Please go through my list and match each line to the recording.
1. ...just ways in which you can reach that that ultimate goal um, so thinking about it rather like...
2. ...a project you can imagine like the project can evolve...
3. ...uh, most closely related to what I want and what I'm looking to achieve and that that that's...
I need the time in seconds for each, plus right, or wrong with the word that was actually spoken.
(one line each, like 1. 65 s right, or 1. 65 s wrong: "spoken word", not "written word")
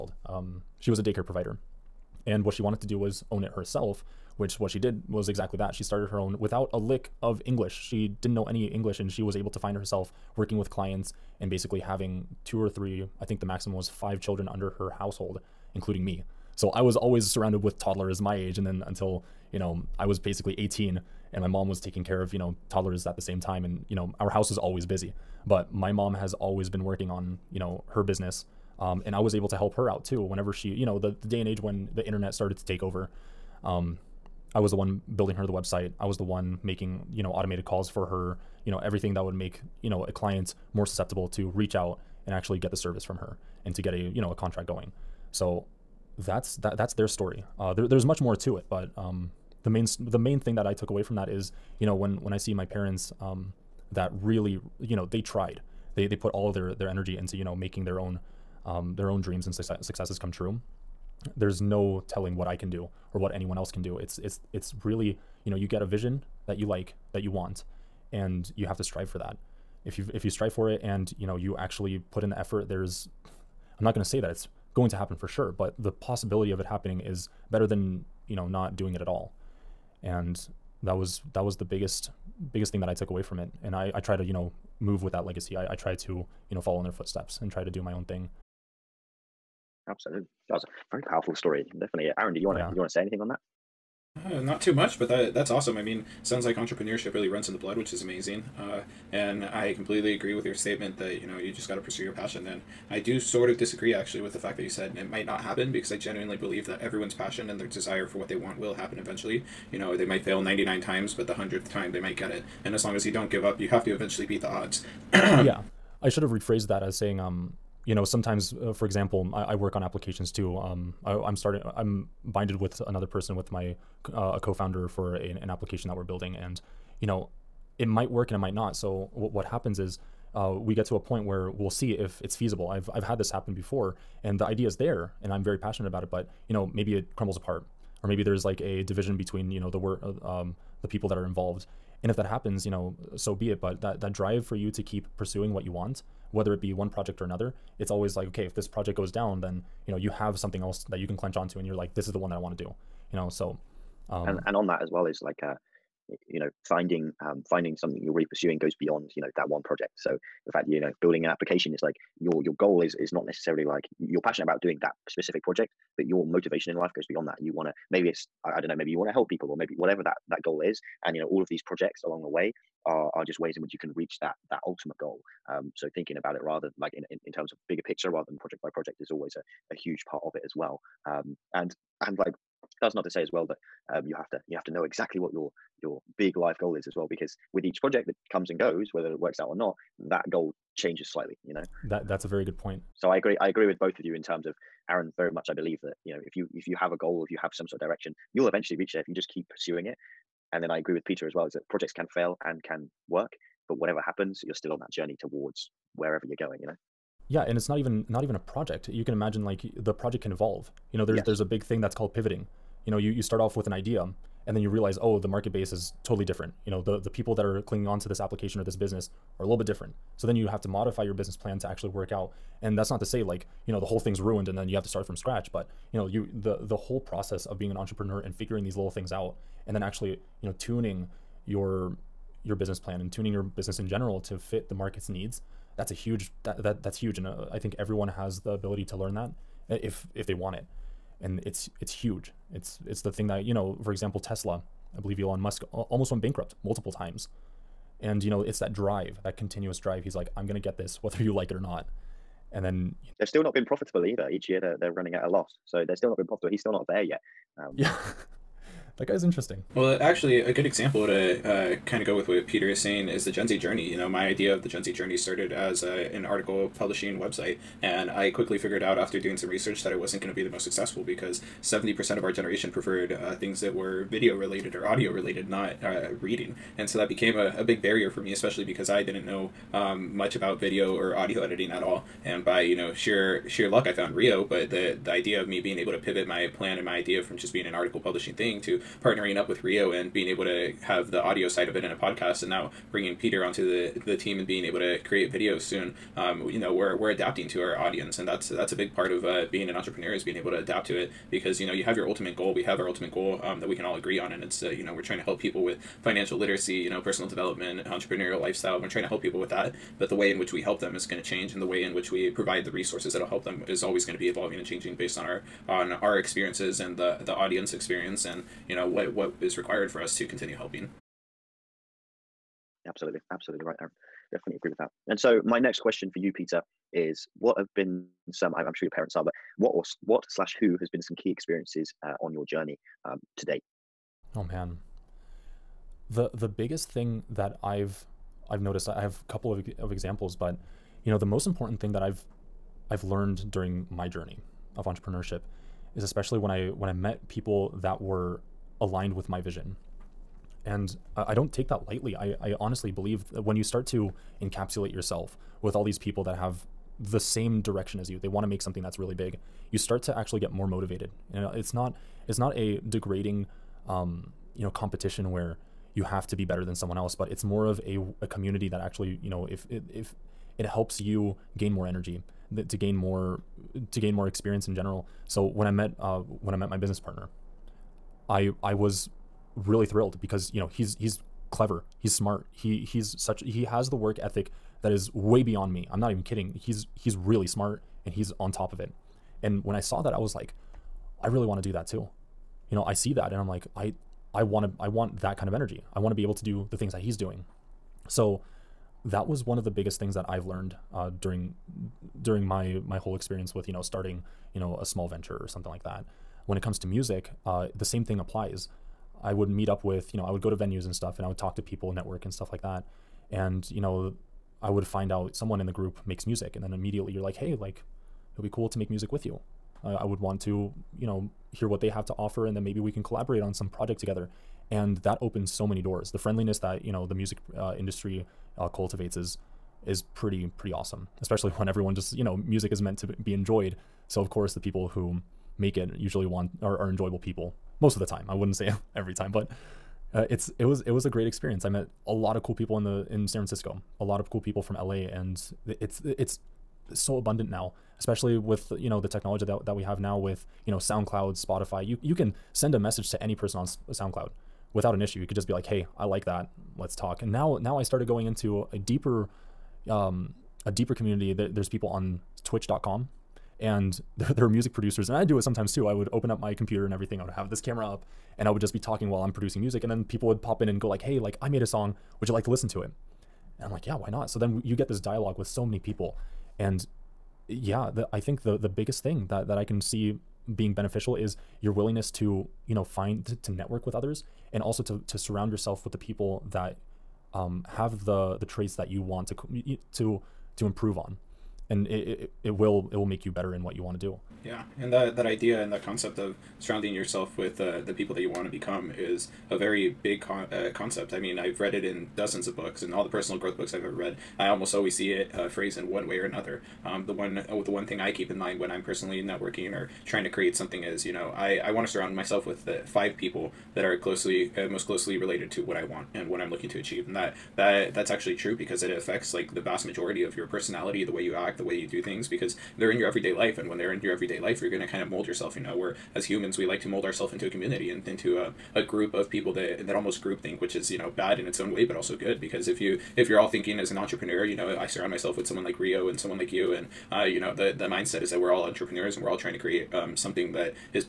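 1. 173 s right
2. 208 s right
3. 514 s right.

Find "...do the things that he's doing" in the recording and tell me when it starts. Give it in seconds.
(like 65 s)
396 s.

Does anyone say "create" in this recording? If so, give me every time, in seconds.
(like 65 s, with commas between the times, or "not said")
295 s, 510 s, 539 s.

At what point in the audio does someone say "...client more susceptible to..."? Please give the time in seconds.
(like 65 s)
40 s.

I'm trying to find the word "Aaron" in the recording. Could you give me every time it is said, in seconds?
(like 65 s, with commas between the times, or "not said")
92 s, 194 s, 323 s.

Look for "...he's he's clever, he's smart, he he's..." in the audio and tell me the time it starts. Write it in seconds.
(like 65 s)
380 s.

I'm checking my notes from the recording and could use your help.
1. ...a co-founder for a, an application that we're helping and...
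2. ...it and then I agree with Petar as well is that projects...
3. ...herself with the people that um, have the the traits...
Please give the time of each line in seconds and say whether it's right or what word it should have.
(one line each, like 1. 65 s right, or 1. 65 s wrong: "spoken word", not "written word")
1. 124 s wrong: "building", not "helping"
2. 199 s right
3. 485 s wrong: "yourself", not "herself".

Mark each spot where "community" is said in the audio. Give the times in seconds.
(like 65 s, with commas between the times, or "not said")
368 s, 460 s, 527 s.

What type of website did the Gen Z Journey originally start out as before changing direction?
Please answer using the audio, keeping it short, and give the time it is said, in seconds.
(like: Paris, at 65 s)
Article publishing website, at 266 s.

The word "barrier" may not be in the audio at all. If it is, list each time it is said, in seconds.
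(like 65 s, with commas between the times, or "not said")
277 s.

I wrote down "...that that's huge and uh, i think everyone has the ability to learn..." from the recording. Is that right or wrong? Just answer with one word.
right.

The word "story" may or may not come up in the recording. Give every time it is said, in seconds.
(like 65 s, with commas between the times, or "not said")
47 s, 91 s.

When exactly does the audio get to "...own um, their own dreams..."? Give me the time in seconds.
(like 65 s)
57 s.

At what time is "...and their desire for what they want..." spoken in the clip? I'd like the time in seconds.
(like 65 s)
107 s.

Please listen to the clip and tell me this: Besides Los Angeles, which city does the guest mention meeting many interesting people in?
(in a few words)
San Francisco.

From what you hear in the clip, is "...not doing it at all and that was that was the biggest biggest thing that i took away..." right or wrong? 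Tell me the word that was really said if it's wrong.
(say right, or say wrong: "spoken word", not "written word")
right.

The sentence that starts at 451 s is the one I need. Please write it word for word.
You you can send a message to any person on SoundCloud without an issue.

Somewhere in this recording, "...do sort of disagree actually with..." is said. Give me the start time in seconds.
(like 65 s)
102 s.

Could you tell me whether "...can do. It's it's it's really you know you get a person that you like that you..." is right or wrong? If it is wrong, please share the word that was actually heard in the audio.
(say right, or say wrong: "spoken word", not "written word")
wrong: "vision", not "person".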